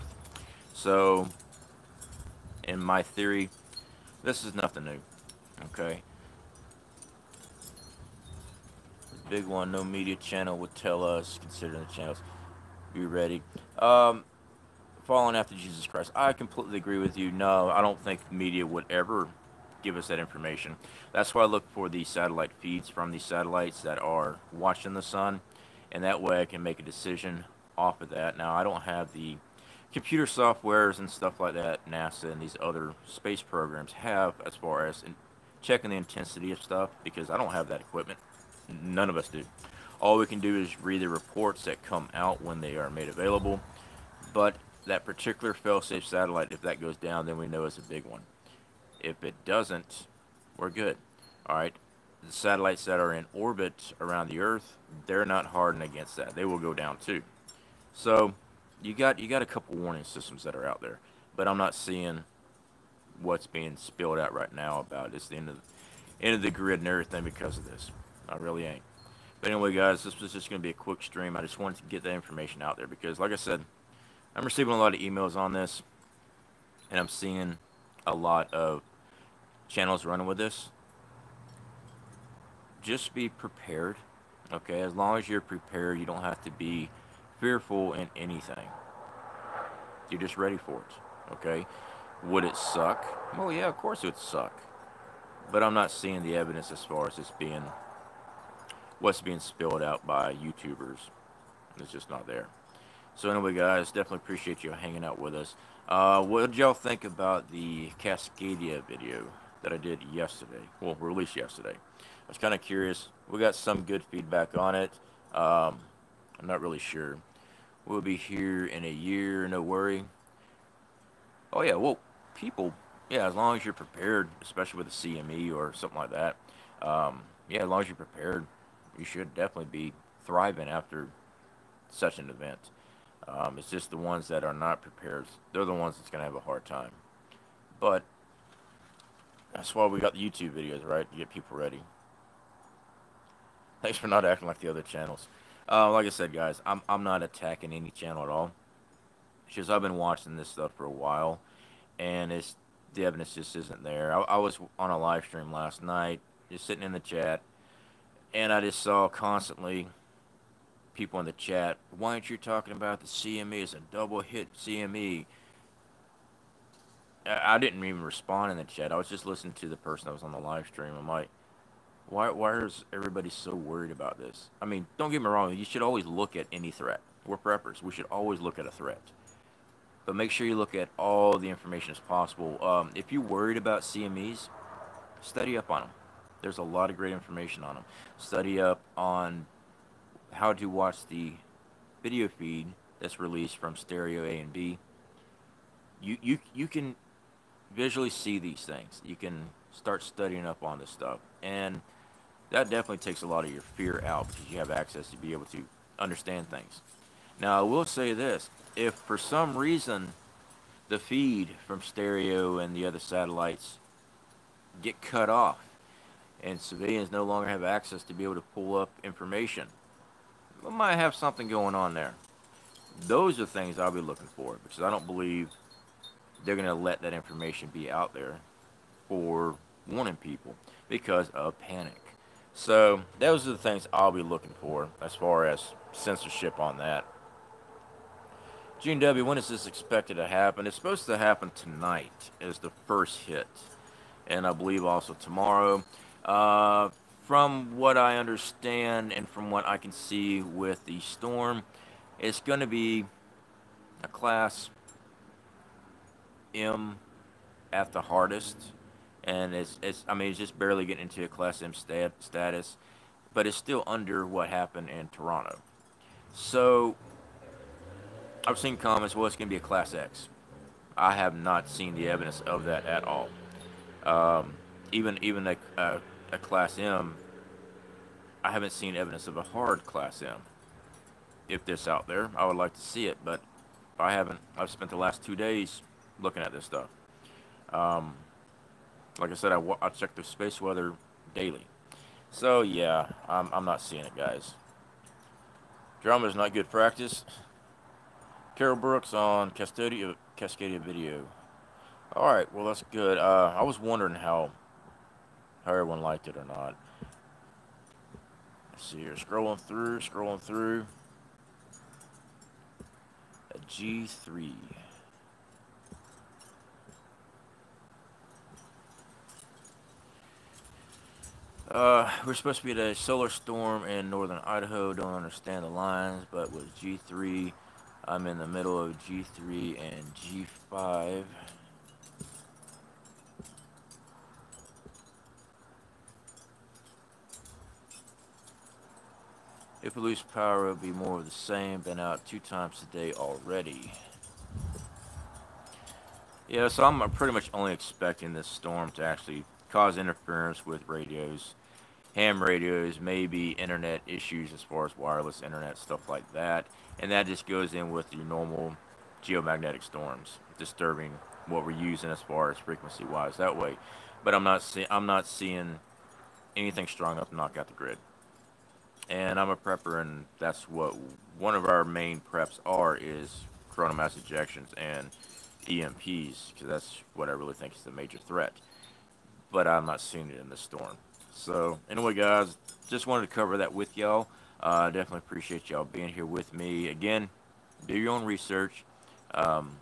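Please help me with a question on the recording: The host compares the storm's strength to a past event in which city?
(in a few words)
Toronto.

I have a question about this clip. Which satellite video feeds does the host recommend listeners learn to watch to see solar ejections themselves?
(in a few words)
STEREO A and B.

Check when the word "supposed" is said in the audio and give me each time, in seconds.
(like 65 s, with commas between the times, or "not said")
240 s, 322 s.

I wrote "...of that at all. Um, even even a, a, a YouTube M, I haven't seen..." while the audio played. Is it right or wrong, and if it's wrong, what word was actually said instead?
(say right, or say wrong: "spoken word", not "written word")
wrong: "Class", not "YouTube".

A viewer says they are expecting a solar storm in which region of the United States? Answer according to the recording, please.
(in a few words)
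northern Idaho.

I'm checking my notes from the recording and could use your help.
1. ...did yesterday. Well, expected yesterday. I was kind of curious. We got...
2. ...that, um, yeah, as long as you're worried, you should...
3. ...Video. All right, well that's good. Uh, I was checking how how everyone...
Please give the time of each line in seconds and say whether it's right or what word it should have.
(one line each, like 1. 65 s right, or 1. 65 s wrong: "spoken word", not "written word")
1. 109 s wrong: "released", not "expected"
2. 126 s wrong: "prepared", not "worried"
3. 300 s wrong: "wondering", not "checking".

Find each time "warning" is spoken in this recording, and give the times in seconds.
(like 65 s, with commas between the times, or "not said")
59 s, 229 s.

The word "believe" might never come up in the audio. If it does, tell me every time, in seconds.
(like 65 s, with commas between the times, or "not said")
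225 s, 244 s.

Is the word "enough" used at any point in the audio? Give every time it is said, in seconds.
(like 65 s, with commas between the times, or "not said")
367 s.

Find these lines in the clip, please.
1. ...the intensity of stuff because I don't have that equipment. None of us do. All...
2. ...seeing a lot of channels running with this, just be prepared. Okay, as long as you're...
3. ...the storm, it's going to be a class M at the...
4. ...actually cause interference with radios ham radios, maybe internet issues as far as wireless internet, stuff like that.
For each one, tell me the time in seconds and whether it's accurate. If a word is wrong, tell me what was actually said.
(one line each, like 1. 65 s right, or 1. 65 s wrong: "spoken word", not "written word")
1. 35 s right
2. 77 s right
3. 250 s right
4. 349 s right.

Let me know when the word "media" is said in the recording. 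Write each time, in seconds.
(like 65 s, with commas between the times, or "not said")
9 s, 18 s.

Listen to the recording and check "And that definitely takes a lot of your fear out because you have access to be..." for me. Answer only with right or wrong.
right.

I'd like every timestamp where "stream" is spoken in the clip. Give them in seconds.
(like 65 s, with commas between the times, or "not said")
71 s, 155 s, 170 s.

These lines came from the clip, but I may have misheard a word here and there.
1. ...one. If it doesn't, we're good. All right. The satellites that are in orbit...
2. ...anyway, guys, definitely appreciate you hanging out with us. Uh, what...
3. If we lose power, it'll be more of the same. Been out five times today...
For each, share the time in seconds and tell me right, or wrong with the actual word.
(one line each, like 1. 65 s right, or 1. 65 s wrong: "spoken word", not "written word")
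1. 48 s right
2. 103 s right
3. 339 s wrong: "two", not "five".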